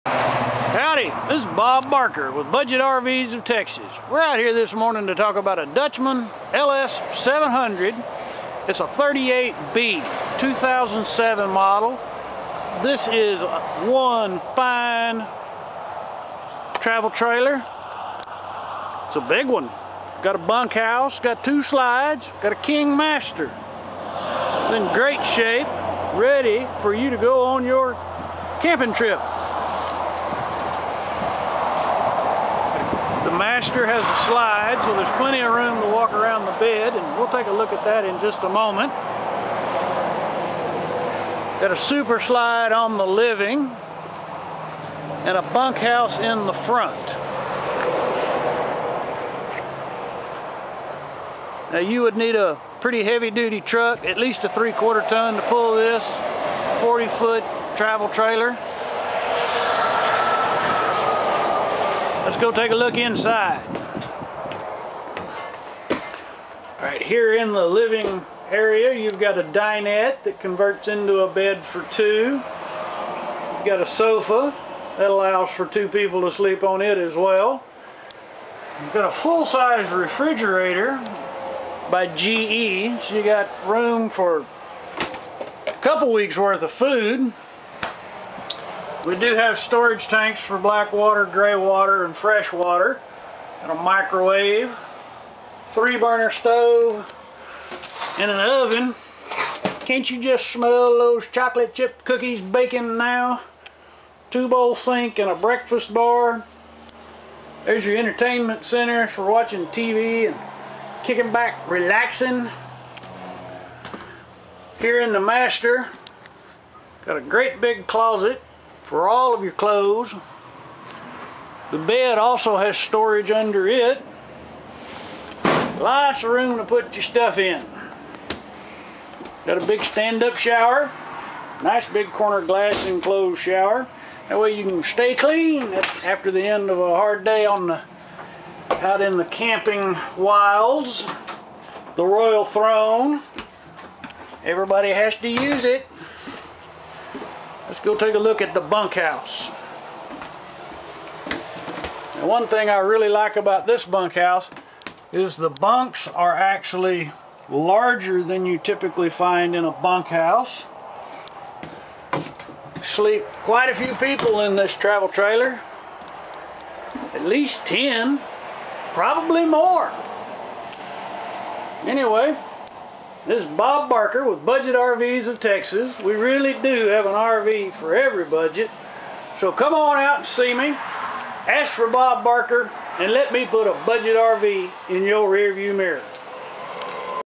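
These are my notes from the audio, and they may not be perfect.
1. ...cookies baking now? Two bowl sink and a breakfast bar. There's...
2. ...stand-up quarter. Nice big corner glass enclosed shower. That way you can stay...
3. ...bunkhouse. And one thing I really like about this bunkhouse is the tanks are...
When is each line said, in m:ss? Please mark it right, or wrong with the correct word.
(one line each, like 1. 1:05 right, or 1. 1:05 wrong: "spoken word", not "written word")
1. 1:42 right
2. 2:09 wrong: "shower", not "quarter"
3. 2:28 wrong: "bunks", not "tanks".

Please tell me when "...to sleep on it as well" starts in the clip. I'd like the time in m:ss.
1:16.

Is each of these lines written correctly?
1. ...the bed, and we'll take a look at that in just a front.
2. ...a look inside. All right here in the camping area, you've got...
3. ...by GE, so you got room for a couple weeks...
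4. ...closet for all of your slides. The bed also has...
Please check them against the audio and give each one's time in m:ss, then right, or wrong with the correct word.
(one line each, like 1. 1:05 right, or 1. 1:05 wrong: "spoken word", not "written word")
1. 0:36 wrong: "moment", not "front"
2. 1:02 wrong: "living", not "camping"
3. 1:21 right
4. 1:57 wrong: "clothes", not "slides".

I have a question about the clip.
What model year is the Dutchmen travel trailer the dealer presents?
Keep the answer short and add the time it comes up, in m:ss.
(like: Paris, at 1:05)
2007, at 0:10.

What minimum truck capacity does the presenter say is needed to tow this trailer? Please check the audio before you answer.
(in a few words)
three quarter ton.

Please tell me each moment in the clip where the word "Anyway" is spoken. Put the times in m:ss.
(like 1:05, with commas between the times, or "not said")
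2:51.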